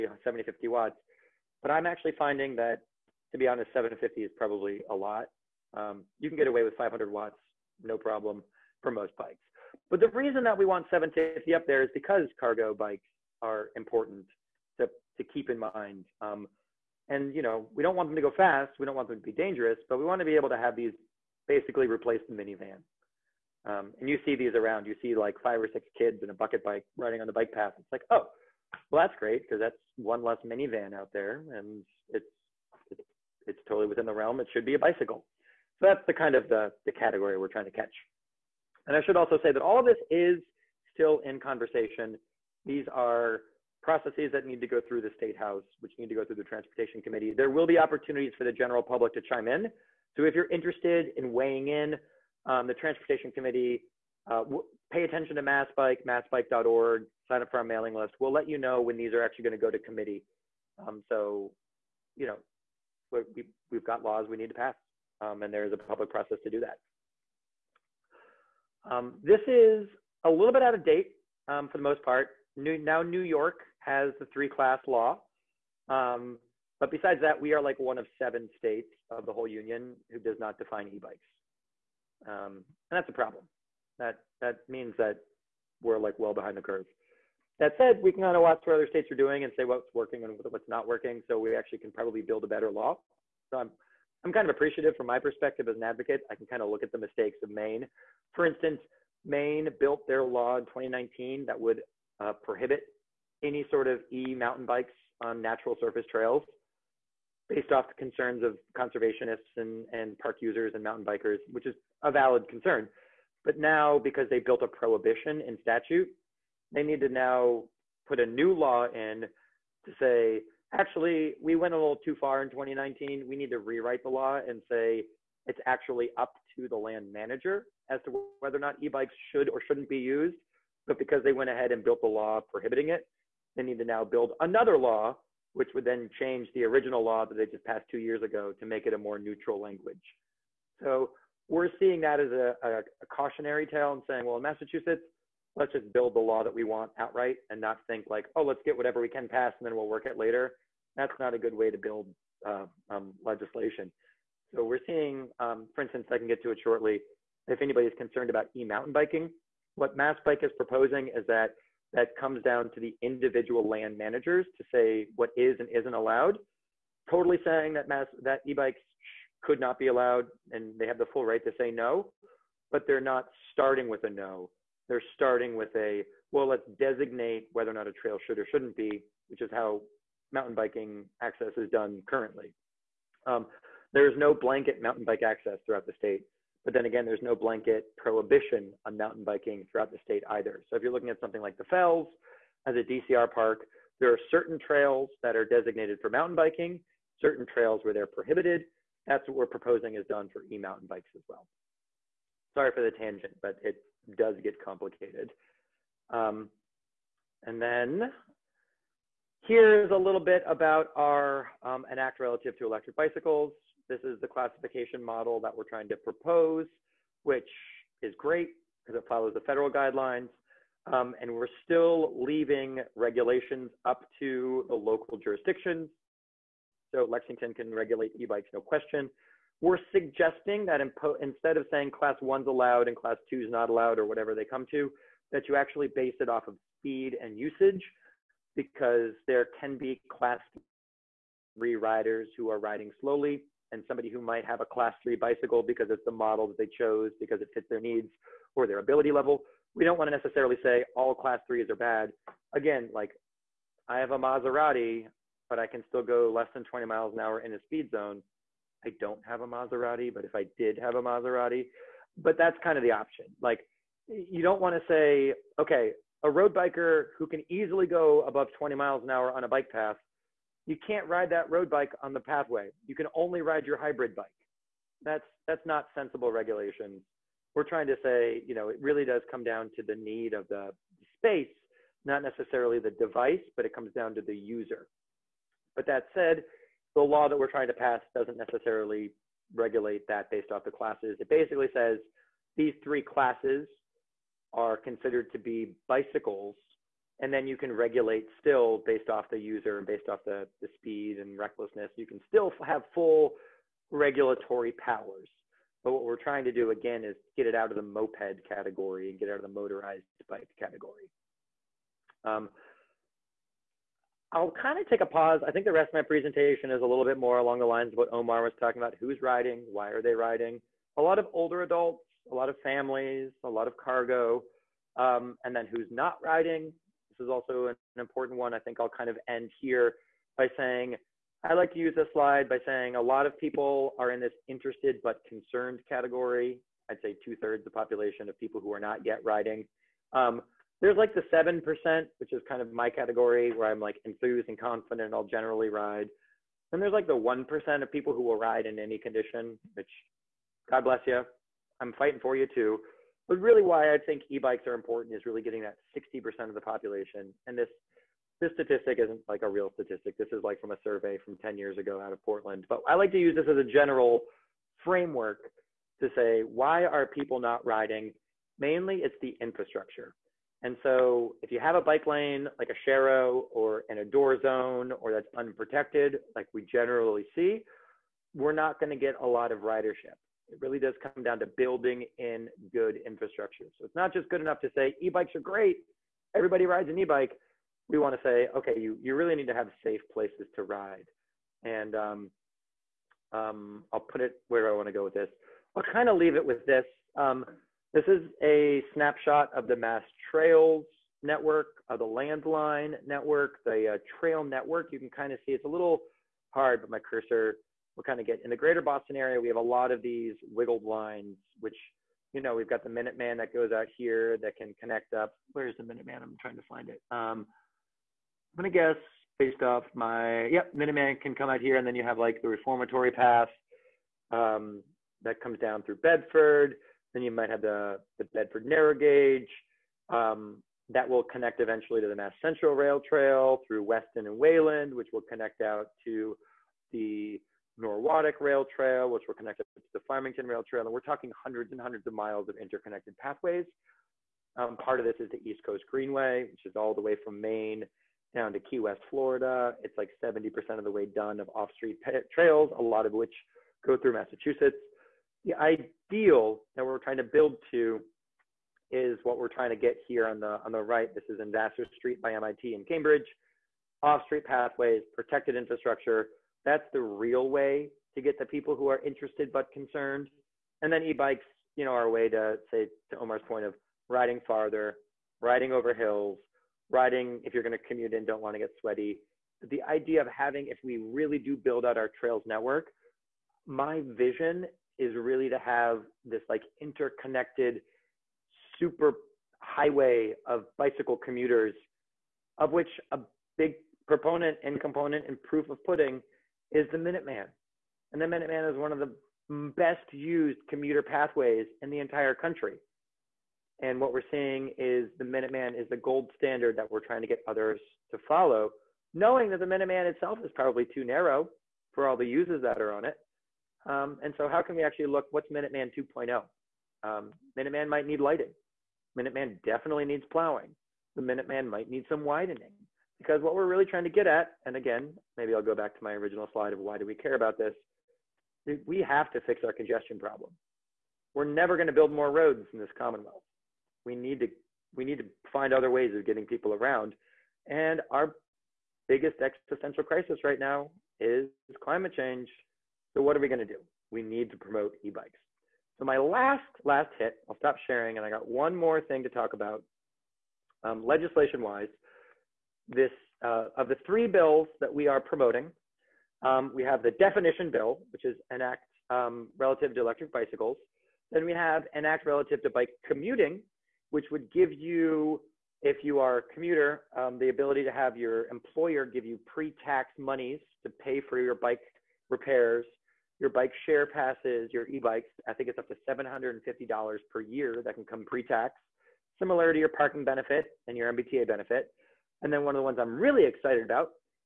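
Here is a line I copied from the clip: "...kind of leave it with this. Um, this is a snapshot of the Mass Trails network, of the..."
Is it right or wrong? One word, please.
right.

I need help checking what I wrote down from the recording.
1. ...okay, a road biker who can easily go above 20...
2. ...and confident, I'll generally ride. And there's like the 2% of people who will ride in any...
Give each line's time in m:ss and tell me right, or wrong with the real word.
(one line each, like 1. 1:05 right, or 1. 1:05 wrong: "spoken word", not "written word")
1. 4:25 right
2. 5:44 wrong: "1", not "2".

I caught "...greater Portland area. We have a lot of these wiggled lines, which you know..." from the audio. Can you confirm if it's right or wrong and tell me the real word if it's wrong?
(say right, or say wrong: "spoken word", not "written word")
wrong: "Boston", not "Portland".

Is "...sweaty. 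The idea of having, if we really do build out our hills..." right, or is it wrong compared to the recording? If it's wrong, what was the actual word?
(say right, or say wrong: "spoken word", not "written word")
wrong: "trails", not "hills".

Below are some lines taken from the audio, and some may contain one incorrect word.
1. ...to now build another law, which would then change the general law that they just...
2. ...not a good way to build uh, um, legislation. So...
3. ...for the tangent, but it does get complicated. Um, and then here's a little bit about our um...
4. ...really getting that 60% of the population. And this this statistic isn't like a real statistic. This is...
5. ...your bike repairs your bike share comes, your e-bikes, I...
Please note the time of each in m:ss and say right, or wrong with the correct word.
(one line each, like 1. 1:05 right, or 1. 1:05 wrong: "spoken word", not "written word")
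1. 2:13 wrong: "original", not "general"
2. 2:31 right
3. 3:22 right
4. 5:55 right
5. 9:31 wrong: "passes", not "comes".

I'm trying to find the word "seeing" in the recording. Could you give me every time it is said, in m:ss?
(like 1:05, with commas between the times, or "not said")
2:21, 2:34, 8:24.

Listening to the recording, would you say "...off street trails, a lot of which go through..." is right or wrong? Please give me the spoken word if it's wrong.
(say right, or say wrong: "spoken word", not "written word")
right.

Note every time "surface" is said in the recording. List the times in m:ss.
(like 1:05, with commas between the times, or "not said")
1:45.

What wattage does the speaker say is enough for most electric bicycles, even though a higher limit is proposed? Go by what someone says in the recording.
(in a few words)
500 watts.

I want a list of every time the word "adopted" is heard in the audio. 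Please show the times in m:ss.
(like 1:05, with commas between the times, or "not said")
not said.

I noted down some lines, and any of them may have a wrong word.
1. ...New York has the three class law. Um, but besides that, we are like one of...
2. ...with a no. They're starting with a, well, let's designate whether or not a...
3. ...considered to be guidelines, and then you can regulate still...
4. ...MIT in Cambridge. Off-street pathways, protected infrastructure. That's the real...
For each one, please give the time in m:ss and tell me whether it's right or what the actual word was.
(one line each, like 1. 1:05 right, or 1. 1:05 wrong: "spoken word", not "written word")
1. 1:13 right
2. 2:53 right
3. 4:54 wrong: "bicycles", not "guidelines"
4. 7:42 right.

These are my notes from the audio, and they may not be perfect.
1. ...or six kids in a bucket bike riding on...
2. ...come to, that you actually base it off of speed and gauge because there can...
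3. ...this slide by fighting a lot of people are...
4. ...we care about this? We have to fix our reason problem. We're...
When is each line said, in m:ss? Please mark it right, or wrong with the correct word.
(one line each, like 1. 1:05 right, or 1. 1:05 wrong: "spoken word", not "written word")
1. 0:25 right
2. 3:54 wrong: "usage", not "gauge"
3. 5:31 wrong: "saying", not "fighting"
4. 8:47 wrong: "congestion", not "reason".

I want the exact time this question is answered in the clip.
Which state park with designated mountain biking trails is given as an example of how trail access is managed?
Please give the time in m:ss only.
3:11.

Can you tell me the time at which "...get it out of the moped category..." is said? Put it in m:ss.
5:07.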